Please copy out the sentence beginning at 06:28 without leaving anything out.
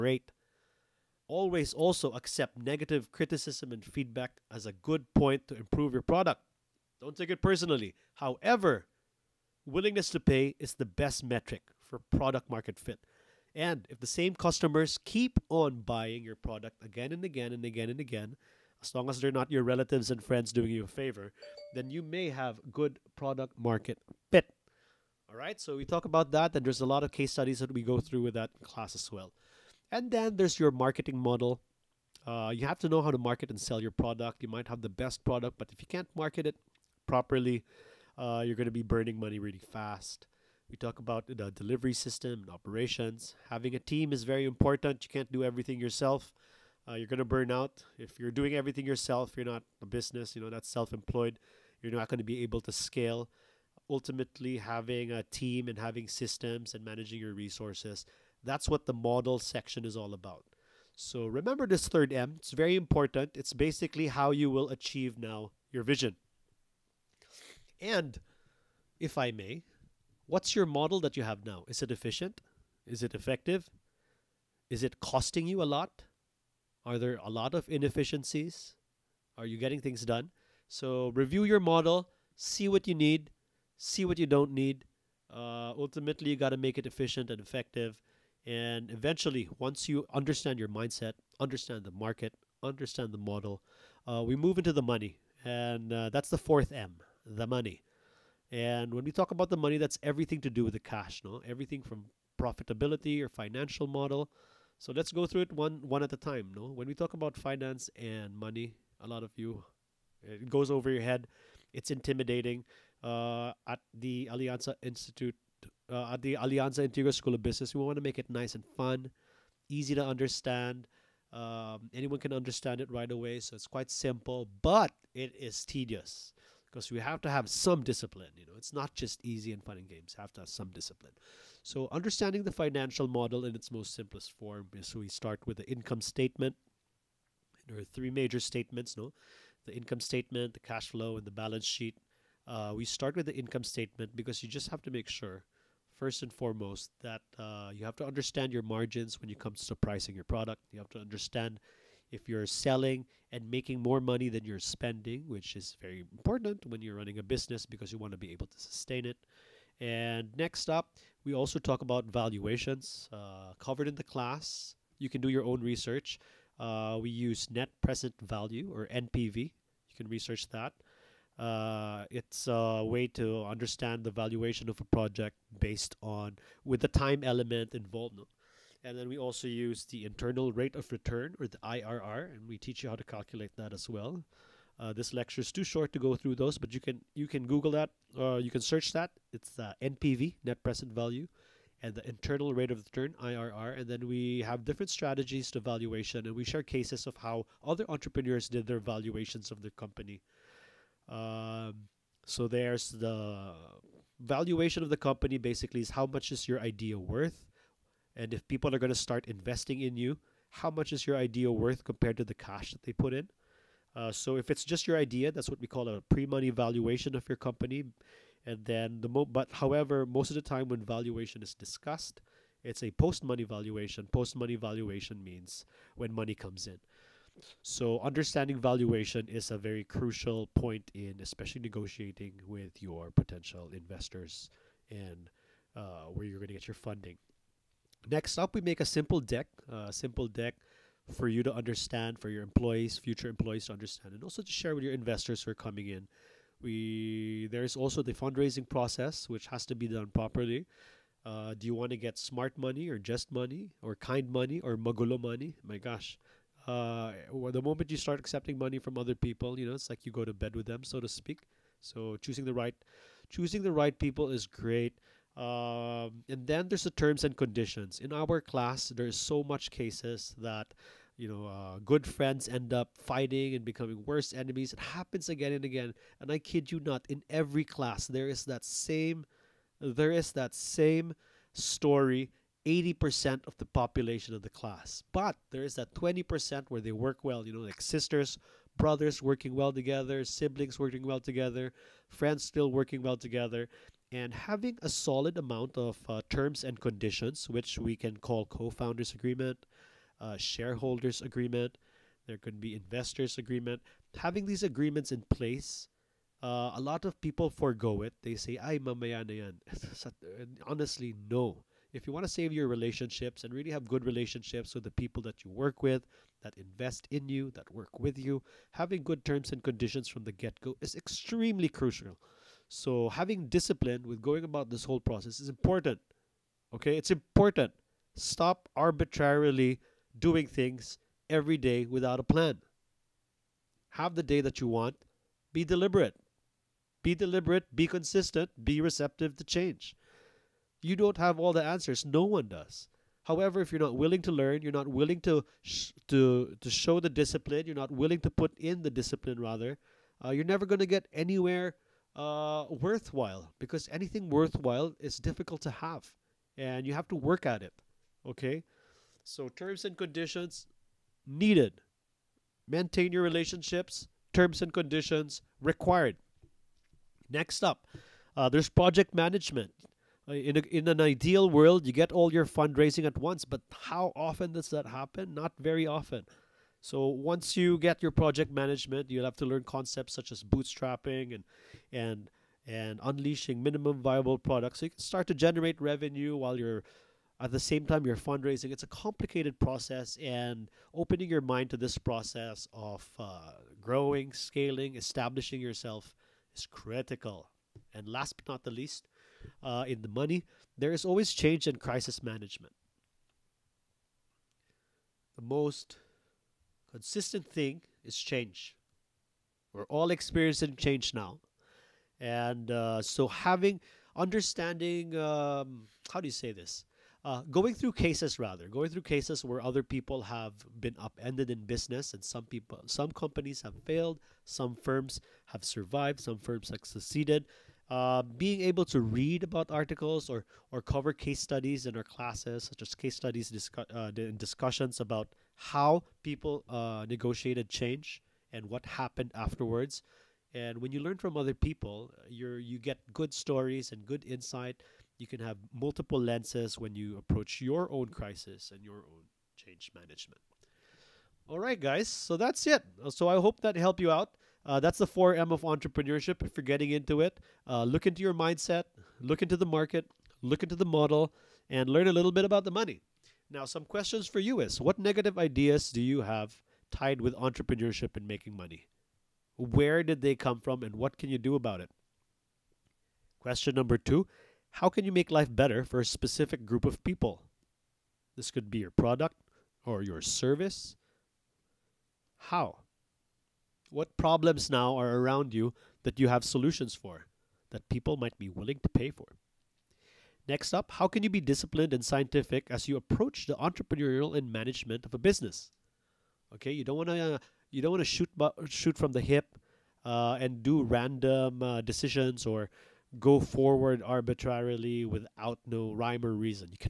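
It's a complicated process, and opening your mind to this process of uh, growing, scaling, establishing yourself is critical.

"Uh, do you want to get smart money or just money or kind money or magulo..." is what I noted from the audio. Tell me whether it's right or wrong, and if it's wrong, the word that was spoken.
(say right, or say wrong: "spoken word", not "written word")
right.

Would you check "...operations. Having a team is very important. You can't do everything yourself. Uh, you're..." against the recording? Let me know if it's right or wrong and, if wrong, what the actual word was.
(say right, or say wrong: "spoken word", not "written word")
right.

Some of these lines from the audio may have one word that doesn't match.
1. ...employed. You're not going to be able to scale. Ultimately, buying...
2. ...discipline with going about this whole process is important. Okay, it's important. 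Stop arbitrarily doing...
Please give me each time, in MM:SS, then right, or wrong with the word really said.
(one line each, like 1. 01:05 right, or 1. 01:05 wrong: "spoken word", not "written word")
1. 00:50 wrong: "having", not "buying"
2. 05:23 right.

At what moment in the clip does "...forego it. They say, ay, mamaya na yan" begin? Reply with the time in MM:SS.
05:07.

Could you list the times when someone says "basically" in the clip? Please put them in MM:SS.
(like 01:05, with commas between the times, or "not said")
01:03, 03:25.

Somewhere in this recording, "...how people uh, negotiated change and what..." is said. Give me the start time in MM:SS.
07:15.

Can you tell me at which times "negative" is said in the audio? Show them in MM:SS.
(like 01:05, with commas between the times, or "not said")
00:02, 07:44.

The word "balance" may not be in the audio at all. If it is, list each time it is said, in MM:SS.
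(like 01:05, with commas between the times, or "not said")
02:21.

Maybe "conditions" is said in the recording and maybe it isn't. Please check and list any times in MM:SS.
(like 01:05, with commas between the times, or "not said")
04:27, 04:56, 05:19, 05:59, 06:04.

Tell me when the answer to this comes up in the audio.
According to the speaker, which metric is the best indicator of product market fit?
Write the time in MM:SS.
00:09.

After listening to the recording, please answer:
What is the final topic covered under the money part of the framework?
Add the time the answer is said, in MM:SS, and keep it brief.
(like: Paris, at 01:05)
Change and crisis management, at 06:41.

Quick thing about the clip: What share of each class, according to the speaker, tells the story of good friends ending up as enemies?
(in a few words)
80%.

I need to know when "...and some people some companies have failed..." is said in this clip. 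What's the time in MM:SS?
07:02.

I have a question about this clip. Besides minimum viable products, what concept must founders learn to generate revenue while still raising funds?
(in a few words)
Bootstrapping.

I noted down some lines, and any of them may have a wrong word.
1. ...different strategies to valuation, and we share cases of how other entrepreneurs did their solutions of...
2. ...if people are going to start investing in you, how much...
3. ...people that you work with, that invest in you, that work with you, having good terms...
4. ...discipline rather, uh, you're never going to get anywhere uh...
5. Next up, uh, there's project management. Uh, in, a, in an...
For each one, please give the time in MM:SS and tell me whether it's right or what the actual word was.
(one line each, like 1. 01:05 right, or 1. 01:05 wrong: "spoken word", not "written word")
1. 03:14 wrong: "valuations", not "solutions"
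2. 03:28 right
3. 05:14 right
4. 05:48 right
5. 06:07 right.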